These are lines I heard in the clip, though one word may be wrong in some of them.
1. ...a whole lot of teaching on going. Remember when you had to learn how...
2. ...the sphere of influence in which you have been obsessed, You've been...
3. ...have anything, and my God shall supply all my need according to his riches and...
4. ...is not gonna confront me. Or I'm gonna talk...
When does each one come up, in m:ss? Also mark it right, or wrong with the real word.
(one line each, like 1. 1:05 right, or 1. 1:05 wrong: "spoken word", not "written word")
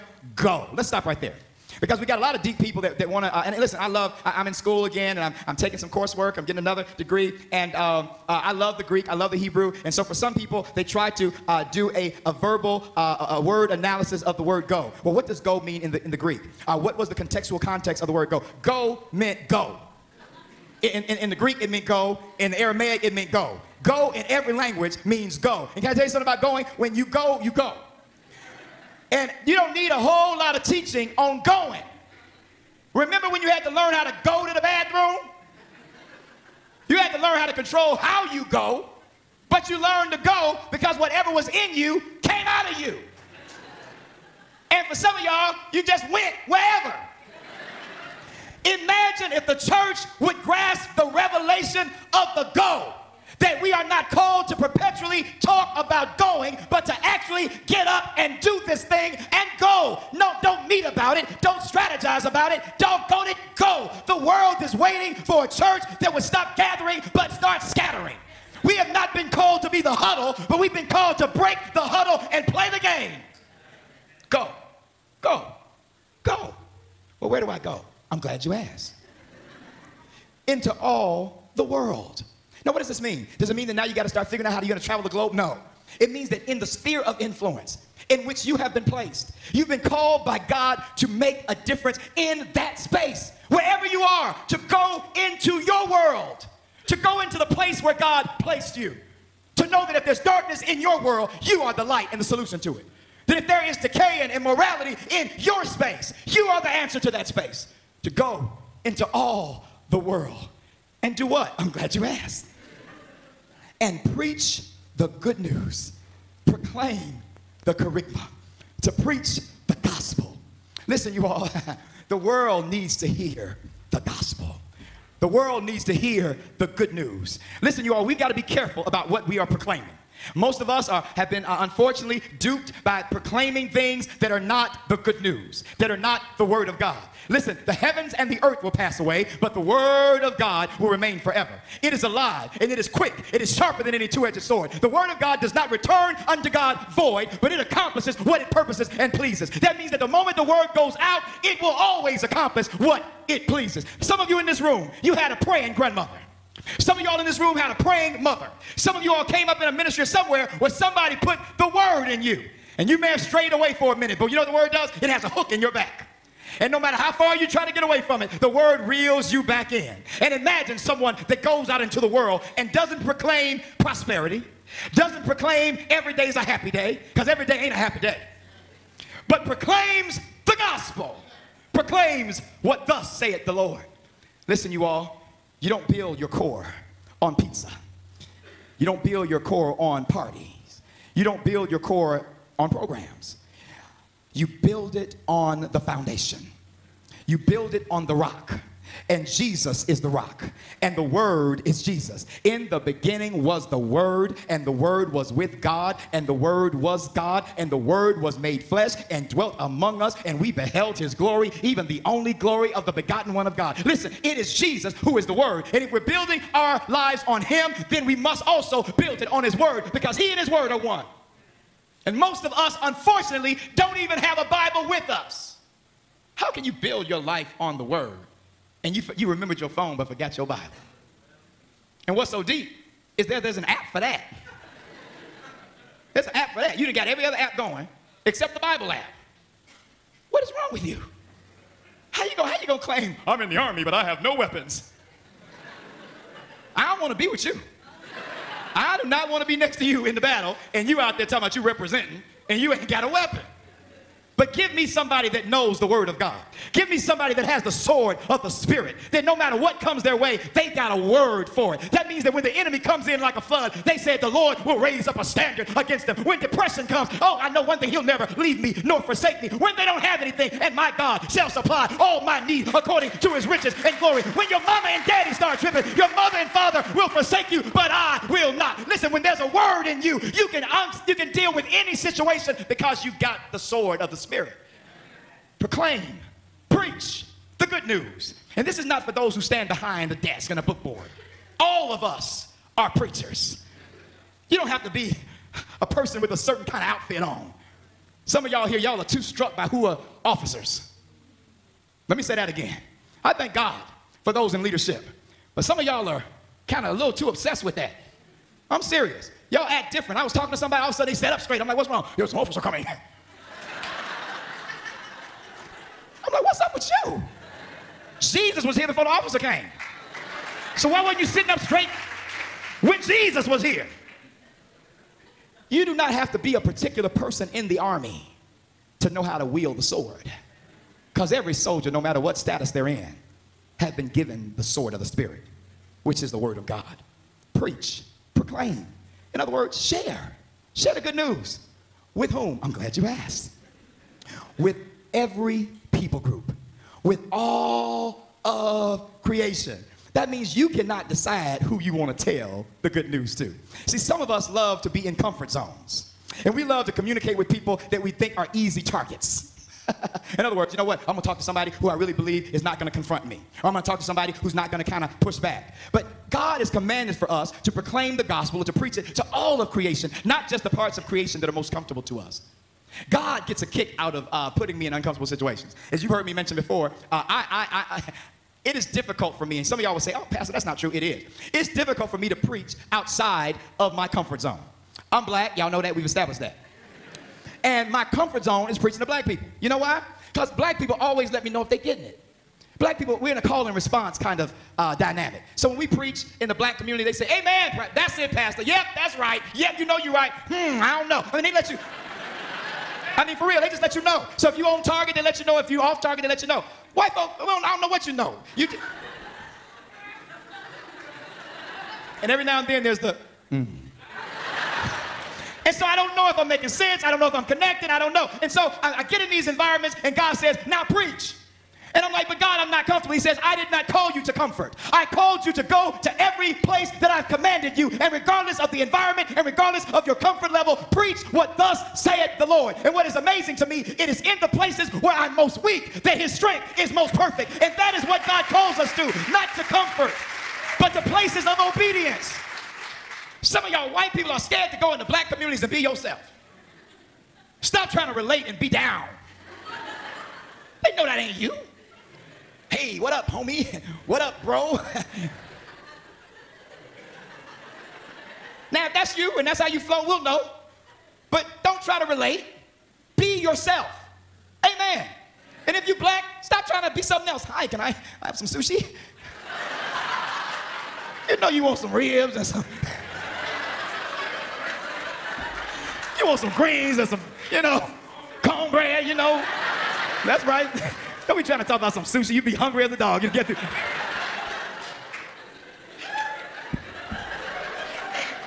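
1. 0:29 right
2. 1:26 wrong: "placed", not "obsessed"
3. 4:29 right
4. 6:02 right.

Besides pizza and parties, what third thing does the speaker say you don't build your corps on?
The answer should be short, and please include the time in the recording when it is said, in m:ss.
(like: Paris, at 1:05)
programs, at 3:12.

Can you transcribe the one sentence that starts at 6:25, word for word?
I'm black, y'all know that, we've established that.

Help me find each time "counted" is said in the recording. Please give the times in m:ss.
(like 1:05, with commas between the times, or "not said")
not said.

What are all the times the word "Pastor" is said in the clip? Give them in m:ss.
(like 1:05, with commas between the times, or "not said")
6:20, 6:38.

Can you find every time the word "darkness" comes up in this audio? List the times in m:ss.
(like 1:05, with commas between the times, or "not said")
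1:40.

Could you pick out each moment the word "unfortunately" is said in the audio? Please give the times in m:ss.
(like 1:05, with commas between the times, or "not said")
2:11, 3:42.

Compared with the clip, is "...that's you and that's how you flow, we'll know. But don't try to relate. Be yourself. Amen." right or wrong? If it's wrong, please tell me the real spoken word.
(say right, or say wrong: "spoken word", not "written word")
right.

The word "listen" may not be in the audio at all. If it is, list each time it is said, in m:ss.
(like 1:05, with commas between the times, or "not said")
0:03, 2:00, 2:07, 2:17, 3:04, 3:33, 4:39.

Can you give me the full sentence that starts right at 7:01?
And I'm like, but God, I'm not comfortable.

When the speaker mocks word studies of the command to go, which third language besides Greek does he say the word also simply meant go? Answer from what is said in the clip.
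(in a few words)
Aramaic.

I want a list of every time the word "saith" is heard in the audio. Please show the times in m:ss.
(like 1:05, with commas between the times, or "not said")
3:03, 7:11.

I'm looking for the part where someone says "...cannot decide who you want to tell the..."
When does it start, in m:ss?
5:50.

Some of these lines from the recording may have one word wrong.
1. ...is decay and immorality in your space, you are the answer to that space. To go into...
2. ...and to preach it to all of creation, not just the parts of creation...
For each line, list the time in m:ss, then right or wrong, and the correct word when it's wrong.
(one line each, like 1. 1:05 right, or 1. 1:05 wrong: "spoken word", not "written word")
1. 1:43 right
2. 6:08 right.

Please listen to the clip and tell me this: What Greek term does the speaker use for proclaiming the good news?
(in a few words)
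kerygma.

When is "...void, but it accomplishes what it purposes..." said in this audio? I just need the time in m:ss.
2:26.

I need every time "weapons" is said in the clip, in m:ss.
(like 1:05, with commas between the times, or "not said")
4:04, 4:13.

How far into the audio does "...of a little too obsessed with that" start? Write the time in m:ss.
5:06.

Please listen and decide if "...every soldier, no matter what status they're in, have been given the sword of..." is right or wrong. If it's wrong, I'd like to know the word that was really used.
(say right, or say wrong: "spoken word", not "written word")
right.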